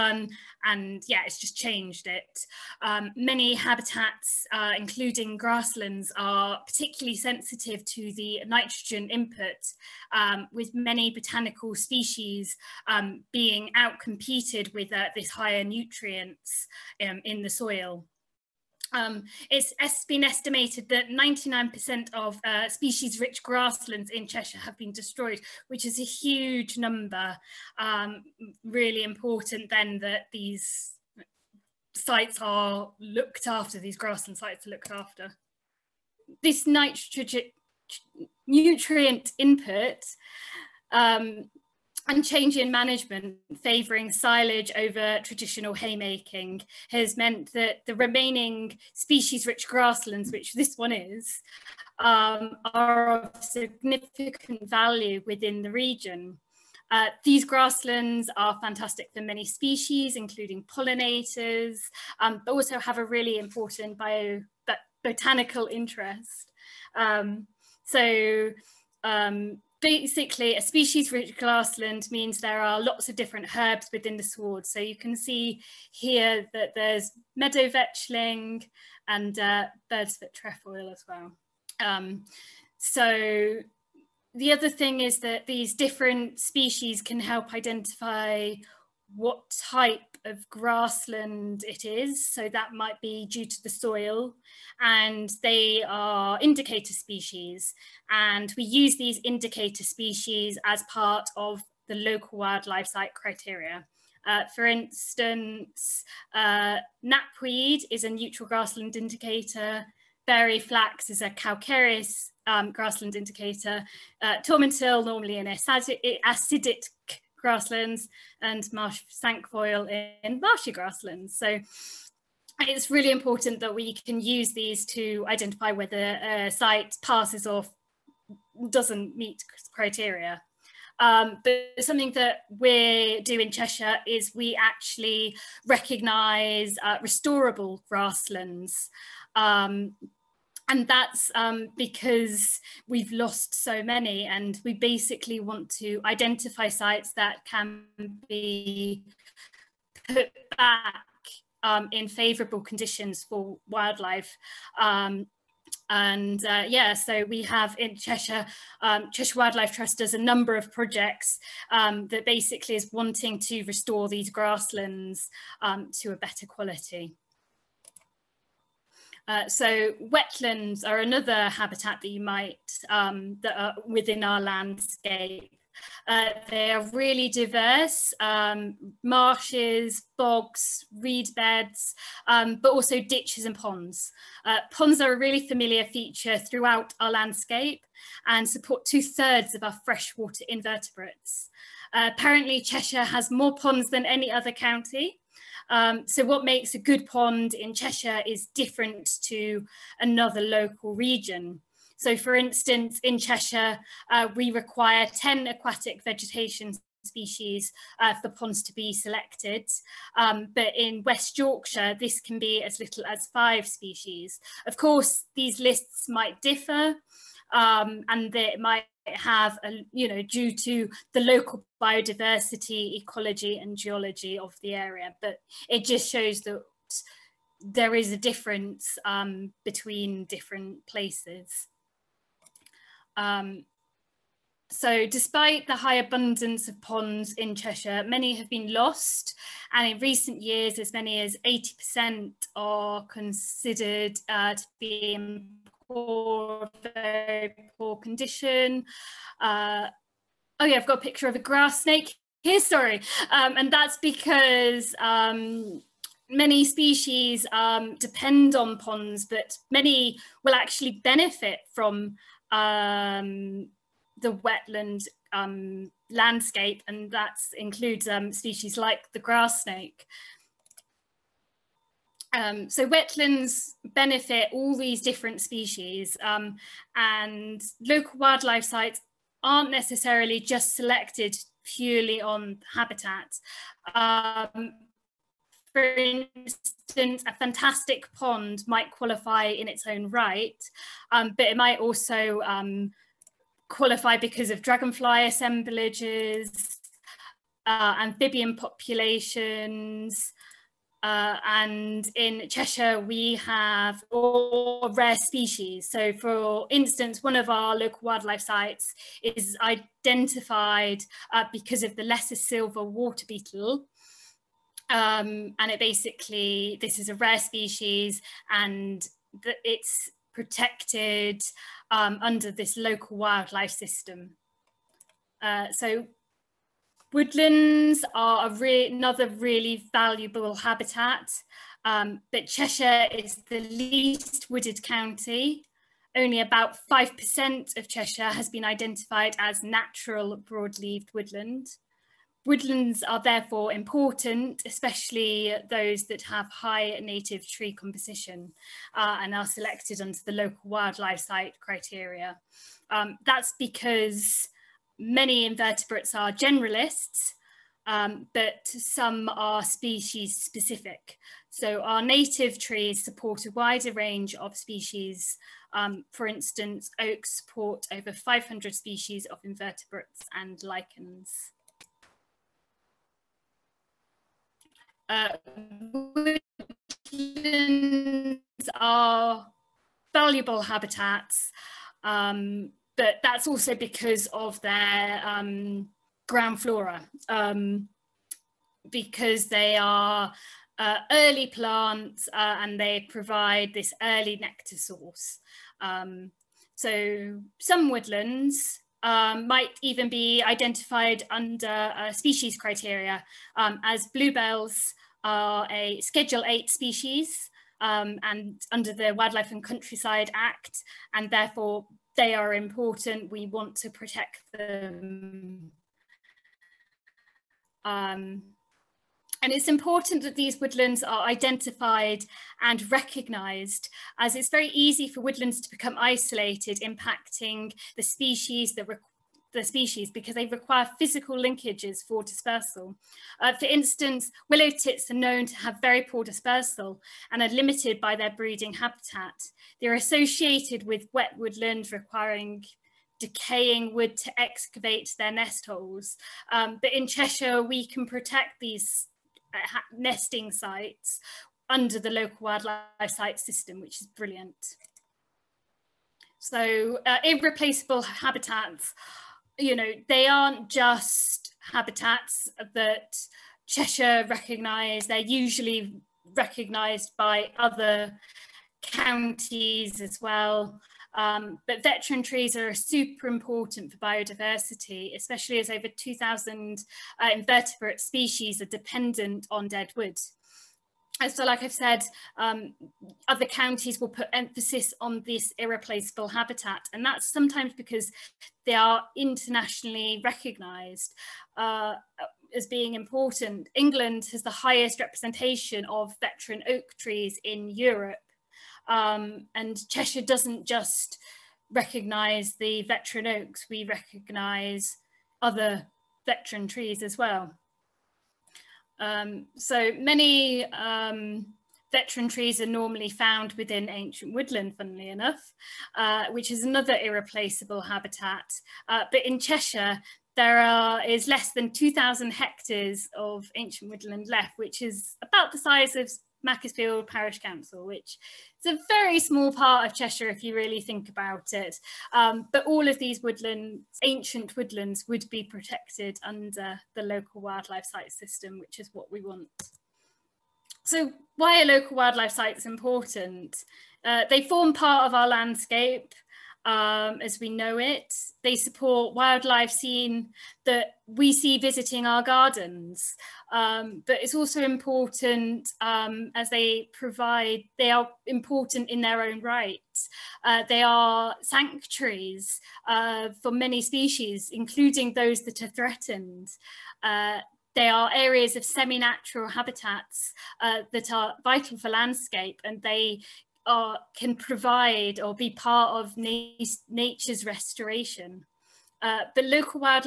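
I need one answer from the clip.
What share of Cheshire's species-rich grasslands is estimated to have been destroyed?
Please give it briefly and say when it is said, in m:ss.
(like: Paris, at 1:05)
99%, at 0:21.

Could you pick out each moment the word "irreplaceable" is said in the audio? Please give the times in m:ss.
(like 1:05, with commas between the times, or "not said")
7:37, 8:05, 8:36.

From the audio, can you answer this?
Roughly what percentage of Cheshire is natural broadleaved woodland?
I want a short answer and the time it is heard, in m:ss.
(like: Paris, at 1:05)
5%, at 5:36.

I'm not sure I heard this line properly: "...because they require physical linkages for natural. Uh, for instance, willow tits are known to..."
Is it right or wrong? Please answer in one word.
wrong.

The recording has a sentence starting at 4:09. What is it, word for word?
Uh, oh yeah, I've got a picture of a grass snake here, sorry.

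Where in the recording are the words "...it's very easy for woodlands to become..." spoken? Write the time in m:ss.
7:04.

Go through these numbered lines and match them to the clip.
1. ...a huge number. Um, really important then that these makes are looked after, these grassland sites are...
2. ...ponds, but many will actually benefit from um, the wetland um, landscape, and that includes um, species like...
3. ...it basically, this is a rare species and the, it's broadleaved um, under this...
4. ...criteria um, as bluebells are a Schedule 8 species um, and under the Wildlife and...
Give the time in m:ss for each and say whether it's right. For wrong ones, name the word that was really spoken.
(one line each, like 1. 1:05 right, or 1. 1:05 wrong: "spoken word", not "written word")
1. 0:25 wrong: "sites", not "makes"
2. 4:18 right
3. 5:15 wrong: "protected", not "broadleaved"
4. 6:42 right.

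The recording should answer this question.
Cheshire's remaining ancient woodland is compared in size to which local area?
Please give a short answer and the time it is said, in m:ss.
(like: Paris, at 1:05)
Macclesfield Parish Council, at 8:46.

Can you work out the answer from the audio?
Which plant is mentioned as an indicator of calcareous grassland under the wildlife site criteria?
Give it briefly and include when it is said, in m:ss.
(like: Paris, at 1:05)
Fairy flax, at 1:50.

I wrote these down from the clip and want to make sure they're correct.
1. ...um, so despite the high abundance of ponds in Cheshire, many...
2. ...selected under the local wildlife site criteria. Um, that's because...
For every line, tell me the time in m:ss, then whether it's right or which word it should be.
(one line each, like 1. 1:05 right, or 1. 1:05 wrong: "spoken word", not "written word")
1. 3:53 right
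2. 5:49 right.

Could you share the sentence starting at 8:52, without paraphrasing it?
Um, but all of these woodlands, ancient woodlands, would be protected under the local wildlife site system, which is what we want.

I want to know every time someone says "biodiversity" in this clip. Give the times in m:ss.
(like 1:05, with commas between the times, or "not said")
3:41, 7:53.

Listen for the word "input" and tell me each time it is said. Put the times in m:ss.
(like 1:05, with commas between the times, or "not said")
0:09, 0:39.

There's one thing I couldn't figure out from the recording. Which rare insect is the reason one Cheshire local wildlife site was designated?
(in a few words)
Lesser silver water beetle.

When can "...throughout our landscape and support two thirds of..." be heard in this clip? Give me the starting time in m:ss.
3:06.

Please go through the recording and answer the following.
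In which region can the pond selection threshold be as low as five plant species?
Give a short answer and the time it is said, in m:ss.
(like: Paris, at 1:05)
West Yorkshire, at 3:31.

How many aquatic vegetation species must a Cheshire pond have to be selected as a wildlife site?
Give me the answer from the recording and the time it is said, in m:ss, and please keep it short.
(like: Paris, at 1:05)
10, at 3:25.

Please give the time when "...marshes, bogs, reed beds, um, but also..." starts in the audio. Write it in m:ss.
2:59.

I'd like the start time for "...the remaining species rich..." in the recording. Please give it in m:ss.
0:47.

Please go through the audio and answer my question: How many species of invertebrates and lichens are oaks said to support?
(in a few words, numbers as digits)
over 500.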